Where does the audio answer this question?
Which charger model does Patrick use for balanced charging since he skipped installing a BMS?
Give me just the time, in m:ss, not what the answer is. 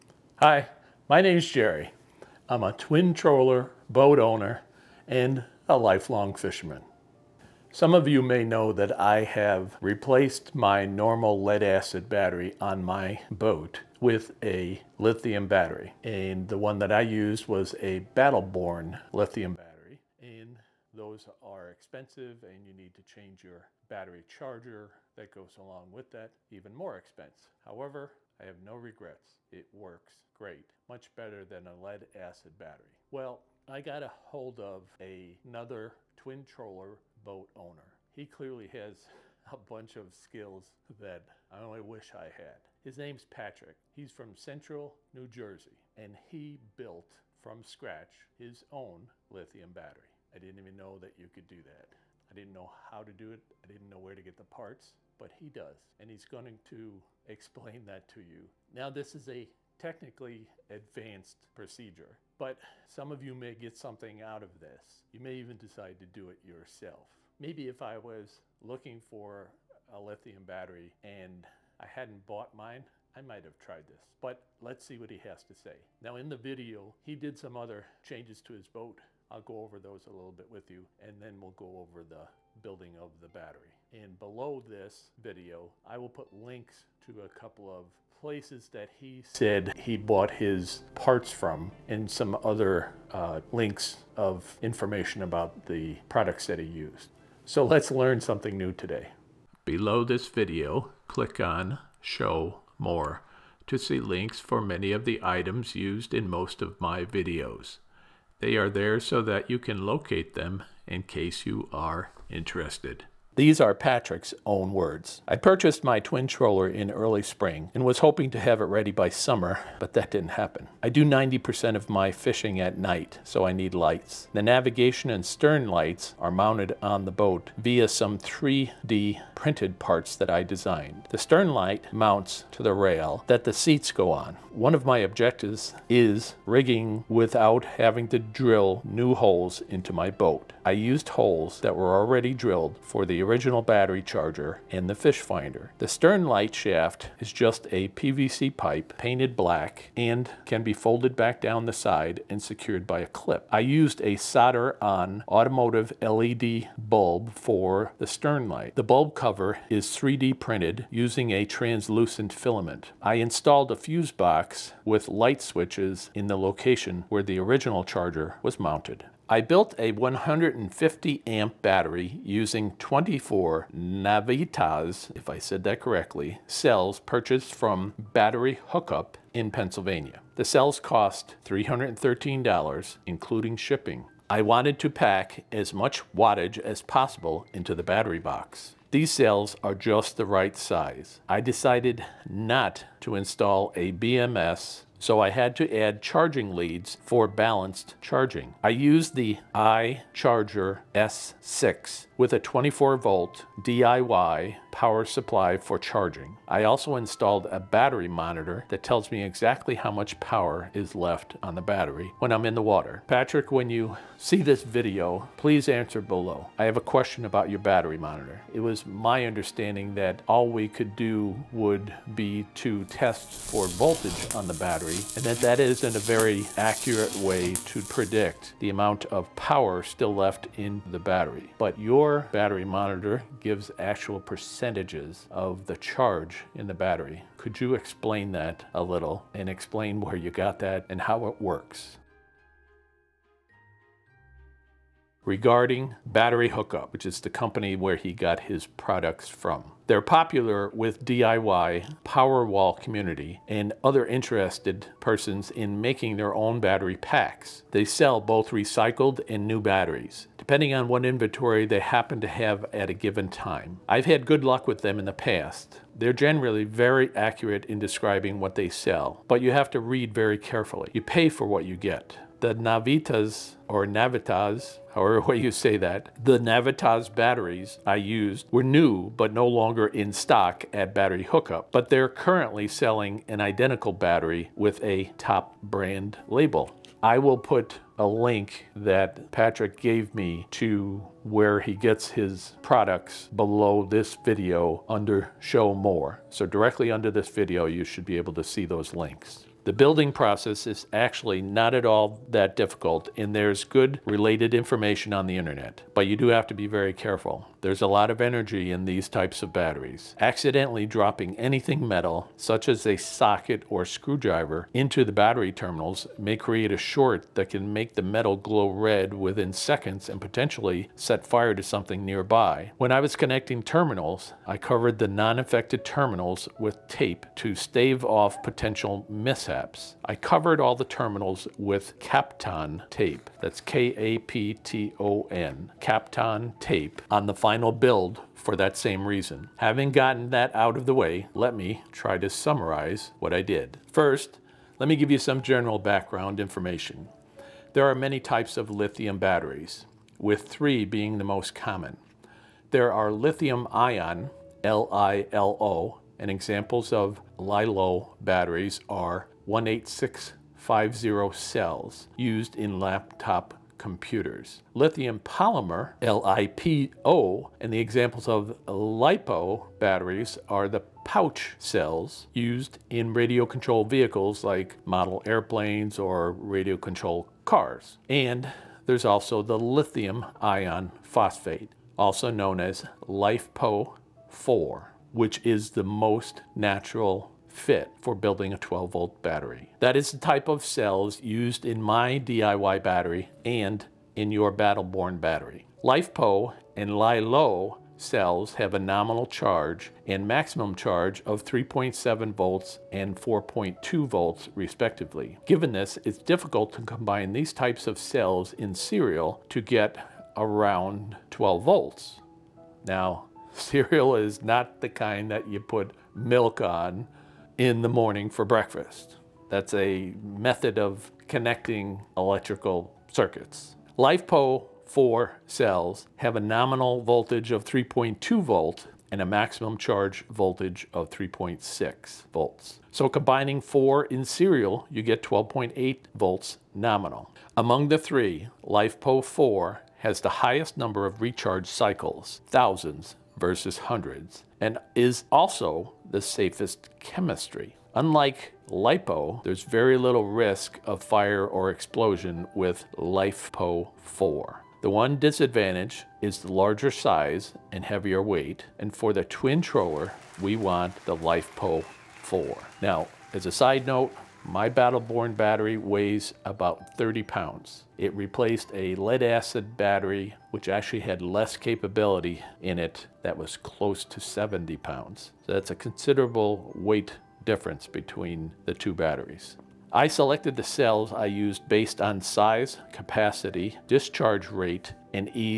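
3:19.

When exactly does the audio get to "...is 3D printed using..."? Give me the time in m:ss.
2:39.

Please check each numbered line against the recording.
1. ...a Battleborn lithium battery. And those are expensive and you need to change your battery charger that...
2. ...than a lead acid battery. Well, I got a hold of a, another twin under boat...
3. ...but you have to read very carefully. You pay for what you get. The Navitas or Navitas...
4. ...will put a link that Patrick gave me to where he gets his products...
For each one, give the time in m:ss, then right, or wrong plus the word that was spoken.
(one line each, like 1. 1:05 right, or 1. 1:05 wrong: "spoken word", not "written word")
1. 0:17 right
2. 0:31 wrong: "troller", not "under"
3. 4:29 right
4. 4:47 right.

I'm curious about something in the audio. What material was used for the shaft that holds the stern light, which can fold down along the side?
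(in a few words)
PVC pipe.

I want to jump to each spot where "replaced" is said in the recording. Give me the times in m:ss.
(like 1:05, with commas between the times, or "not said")
0:09, 7:48.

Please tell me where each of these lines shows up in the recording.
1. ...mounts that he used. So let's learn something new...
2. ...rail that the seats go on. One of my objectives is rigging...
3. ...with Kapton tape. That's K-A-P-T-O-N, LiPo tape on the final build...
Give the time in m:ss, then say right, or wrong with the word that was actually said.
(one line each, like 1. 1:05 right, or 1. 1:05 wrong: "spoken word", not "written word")
1. 1:36 wrong: "products", not "mounts"
2. 2:12 right
3. 5:31 wrong: "Kapton", not "LiPo".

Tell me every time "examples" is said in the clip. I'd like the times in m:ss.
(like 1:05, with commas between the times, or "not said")
5:56, 6:07.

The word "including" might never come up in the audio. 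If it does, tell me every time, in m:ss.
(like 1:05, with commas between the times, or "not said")
3:03.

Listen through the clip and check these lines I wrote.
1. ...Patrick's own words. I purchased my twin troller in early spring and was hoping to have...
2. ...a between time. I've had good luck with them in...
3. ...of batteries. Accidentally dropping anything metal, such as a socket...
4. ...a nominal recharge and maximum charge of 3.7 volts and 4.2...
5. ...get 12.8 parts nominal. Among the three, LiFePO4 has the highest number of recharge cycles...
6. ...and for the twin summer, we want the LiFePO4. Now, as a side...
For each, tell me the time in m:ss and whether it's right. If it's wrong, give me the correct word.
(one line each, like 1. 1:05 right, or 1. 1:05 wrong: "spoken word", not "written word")
1. 1:53 right
2. 4:22 wrong: "given", not "between"
3. 5:09 right
4. 6:38 wrong: "charge", not "recharge"
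5. 7:15 wrong: "volts", not "parts"
6. 7:38 wrong: "troller", not "summer".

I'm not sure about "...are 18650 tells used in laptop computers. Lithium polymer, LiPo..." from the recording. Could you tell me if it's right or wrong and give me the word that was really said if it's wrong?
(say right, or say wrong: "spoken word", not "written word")
wrong: "cells", not "tells".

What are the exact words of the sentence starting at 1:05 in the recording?
You may even decide to do it yourself.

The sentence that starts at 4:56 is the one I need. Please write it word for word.
So directly under this video, you should be able to see those links.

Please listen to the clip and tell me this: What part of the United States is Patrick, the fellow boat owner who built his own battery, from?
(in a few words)
central New Jersey.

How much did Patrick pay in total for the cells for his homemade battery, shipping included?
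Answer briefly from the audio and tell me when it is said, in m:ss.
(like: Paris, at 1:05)
$313, at 3:01.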